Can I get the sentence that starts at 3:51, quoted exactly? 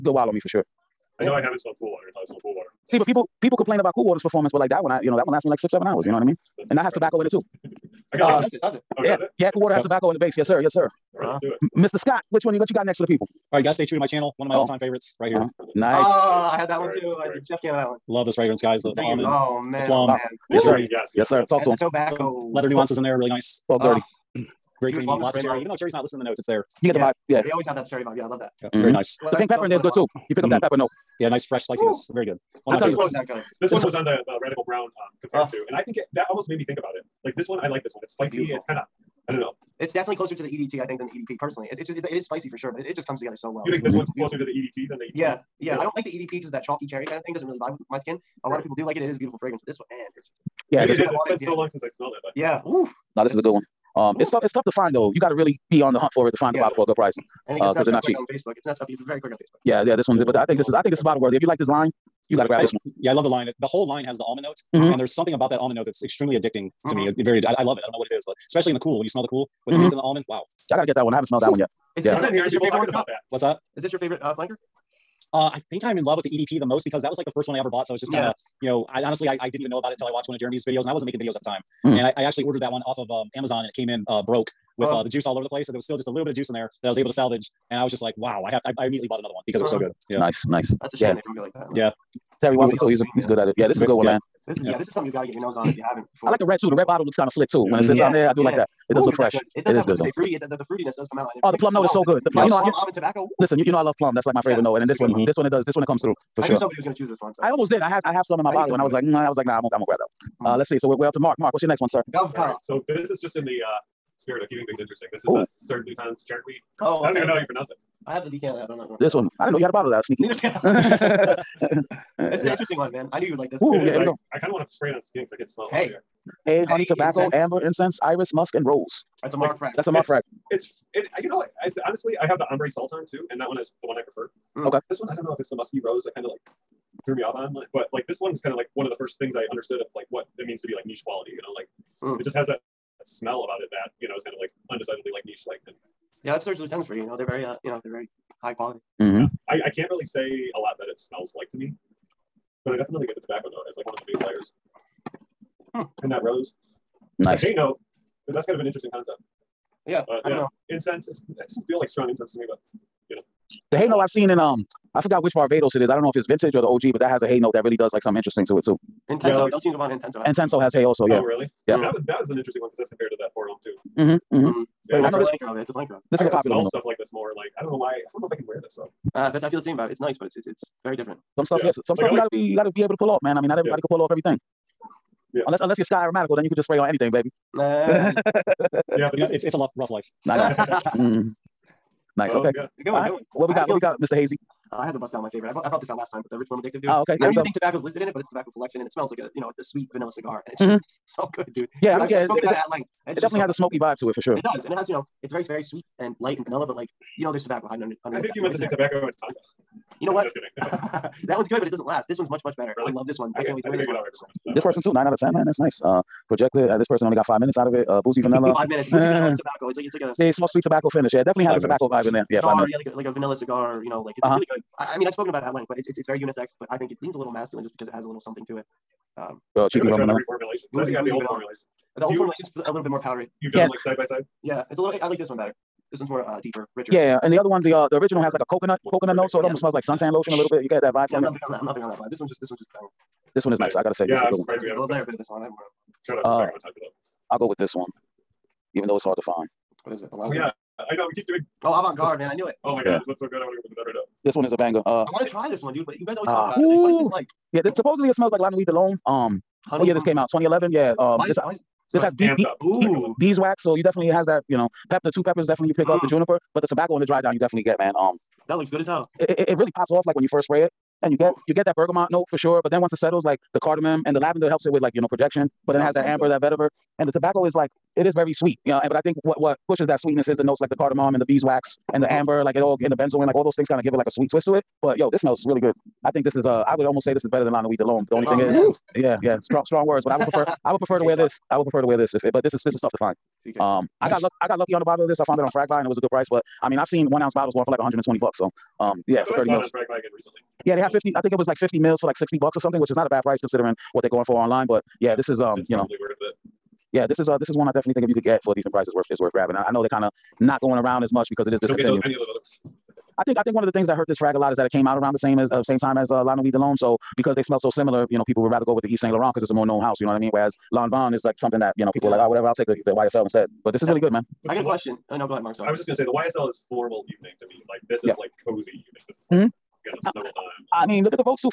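The old you, formulation's a little bit more powdery.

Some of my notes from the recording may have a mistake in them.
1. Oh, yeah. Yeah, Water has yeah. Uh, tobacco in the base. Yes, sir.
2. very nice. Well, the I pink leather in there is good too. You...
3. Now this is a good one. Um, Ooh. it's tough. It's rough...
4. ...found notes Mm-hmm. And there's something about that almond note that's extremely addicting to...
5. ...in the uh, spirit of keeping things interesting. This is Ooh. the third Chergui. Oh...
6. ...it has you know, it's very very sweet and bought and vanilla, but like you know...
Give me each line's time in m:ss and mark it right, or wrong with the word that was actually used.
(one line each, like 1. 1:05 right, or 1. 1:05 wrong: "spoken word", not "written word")
1. 0:08 right
2. 0:28 wrong: "pepper", not "leather"
3. 0:53 wrong: "tough", not "rough"
4. 1:04 wrong: "almond", not "found"
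5. 1:53 right
6. 3:24 wrong: "light", not "bought".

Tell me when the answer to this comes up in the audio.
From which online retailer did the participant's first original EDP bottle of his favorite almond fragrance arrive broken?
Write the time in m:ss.
1:23.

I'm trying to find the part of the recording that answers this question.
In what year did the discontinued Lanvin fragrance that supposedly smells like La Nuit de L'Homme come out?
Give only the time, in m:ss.
4:20.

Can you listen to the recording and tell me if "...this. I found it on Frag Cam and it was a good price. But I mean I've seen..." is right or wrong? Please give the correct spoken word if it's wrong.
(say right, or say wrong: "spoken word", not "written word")
wrong: "Buy", not "Cam".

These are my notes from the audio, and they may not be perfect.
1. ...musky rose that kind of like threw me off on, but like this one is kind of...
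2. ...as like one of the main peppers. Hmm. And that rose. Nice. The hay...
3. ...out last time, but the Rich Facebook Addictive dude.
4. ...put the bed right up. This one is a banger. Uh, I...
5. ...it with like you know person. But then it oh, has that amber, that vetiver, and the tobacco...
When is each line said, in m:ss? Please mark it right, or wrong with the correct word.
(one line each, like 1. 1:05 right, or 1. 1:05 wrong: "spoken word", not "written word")
1. 2:15 right
2. 2:33 wrong: "players", not "peppers"
3. 3:15 wrong: "Warm", not "Facebook"
4. 4:13 right
5. 4:34 wrong: "projection", not "person".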